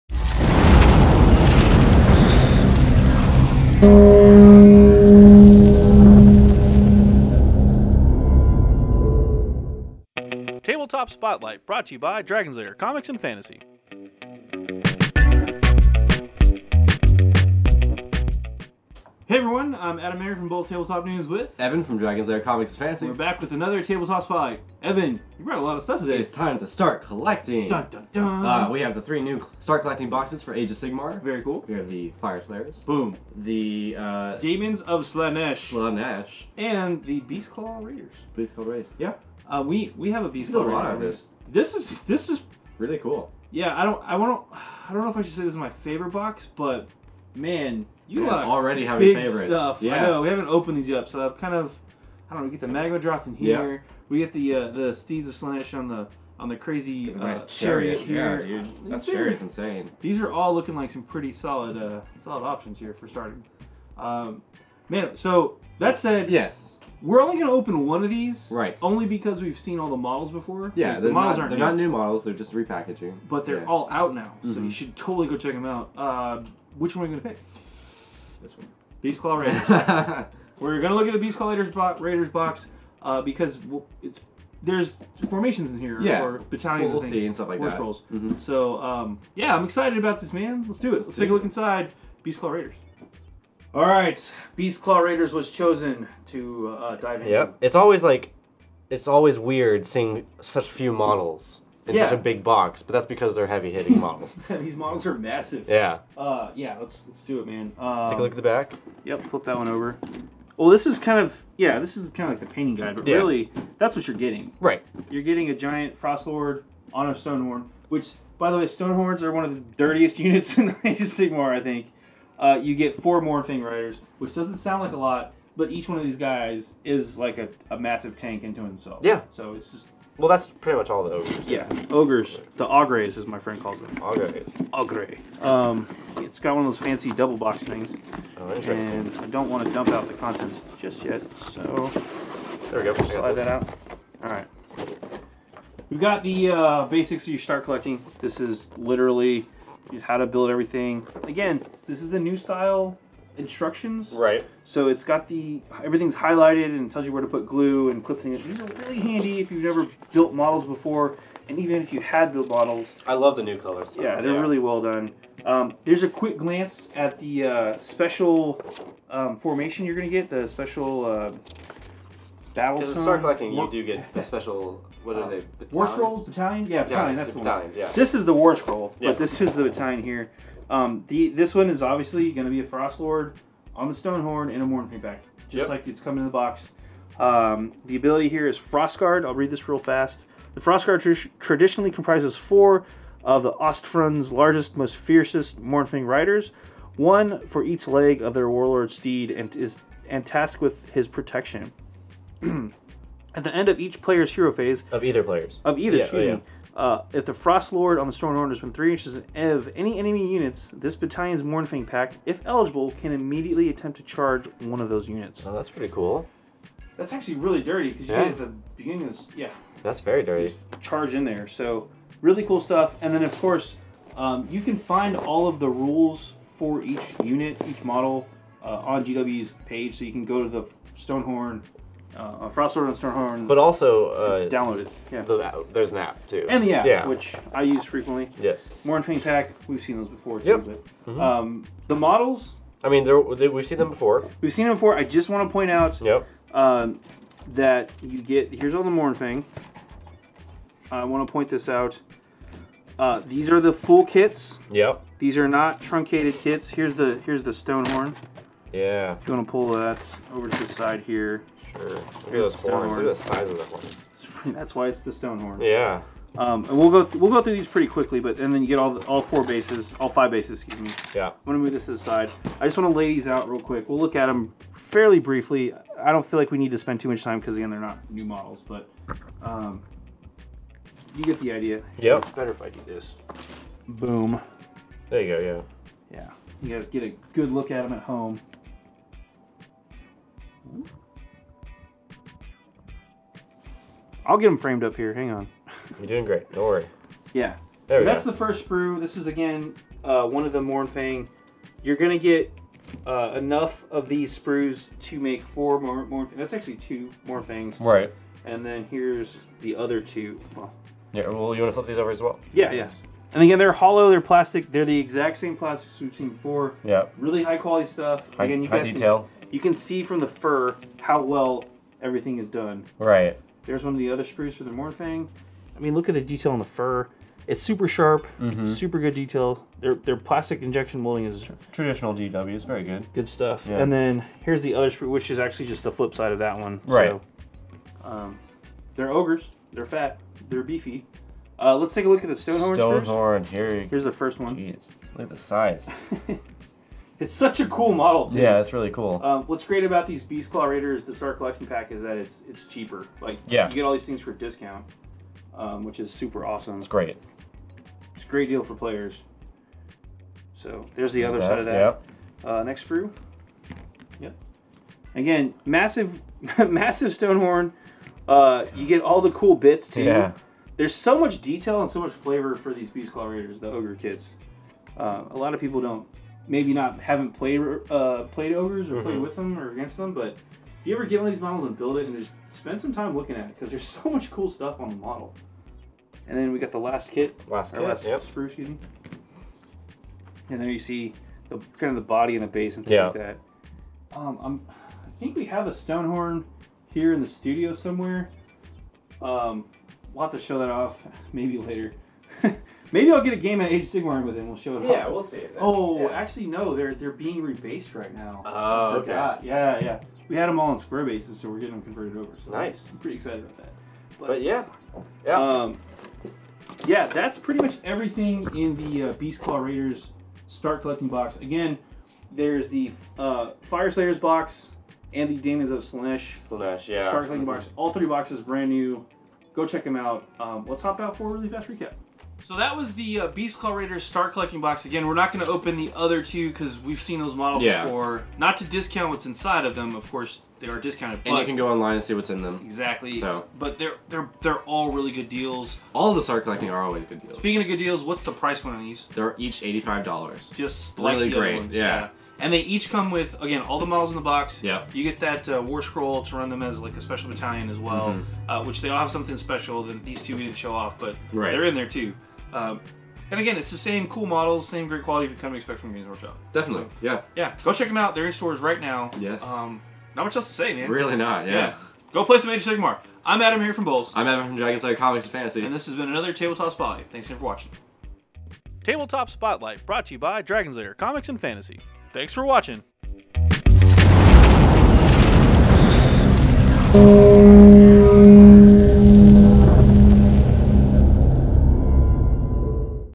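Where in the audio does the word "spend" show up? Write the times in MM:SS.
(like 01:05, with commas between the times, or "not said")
04:36, 06:22.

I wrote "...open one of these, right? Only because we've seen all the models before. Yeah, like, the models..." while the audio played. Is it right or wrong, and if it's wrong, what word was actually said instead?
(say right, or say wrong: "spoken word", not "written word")
right.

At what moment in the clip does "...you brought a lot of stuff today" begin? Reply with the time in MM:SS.
00:25.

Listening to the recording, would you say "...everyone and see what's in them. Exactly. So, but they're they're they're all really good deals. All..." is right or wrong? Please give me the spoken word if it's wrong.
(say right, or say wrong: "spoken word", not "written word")
wrong: "online", not "everyone".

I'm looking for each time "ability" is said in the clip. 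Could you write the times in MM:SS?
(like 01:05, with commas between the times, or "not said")
03:07.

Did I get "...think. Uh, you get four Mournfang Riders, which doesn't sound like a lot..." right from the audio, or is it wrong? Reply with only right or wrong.
right.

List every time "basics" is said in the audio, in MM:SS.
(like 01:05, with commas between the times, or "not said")
02:26.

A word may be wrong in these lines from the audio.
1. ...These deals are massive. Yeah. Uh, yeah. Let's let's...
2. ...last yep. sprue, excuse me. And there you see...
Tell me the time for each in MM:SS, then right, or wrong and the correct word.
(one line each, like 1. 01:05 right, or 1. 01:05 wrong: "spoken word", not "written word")
1. 01:44 wrong: "models", not "deals"
2. 06:27 right.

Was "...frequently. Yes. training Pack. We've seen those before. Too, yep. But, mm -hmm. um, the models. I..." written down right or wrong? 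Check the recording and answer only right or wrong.
right.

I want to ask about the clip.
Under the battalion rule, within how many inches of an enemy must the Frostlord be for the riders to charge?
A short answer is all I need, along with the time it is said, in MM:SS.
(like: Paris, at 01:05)
3, at 03:28.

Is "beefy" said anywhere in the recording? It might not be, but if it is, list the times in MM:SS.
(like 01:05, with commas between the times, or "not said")
05:40.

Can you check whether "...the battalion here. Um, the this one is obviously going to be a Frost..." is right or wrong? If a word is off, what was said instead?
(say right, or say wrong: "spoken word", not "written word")
right.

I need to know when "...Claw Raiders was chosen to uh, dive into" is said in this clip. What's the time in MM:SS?
01:34.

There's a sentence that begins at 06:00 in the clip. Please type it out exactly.
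So there's the other that, side of that.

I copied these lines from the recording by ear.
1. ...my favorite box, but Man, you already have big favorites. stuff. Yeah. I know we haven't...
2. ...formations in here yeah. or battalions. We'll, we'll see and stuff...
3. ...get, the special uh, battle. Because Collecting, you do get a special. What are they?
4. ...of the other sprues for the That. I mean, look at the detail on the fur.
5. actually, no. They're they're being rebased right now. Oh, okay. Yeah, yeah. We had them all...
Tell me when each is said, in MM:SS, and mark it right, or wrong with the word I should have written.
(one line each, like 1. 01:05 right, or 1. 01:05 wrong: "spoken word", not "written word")
1. 00:45 right
2. 01:25 right
3. 02:50 right
4. 05:23 wrong: "Mournfang", not "That"
5. 06:46 right.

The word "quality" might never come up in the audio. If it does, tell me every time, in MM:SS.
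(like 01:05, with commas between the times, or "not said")
05:17, 07:45.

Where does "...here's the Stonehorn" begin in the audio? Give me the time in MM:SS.
04:17.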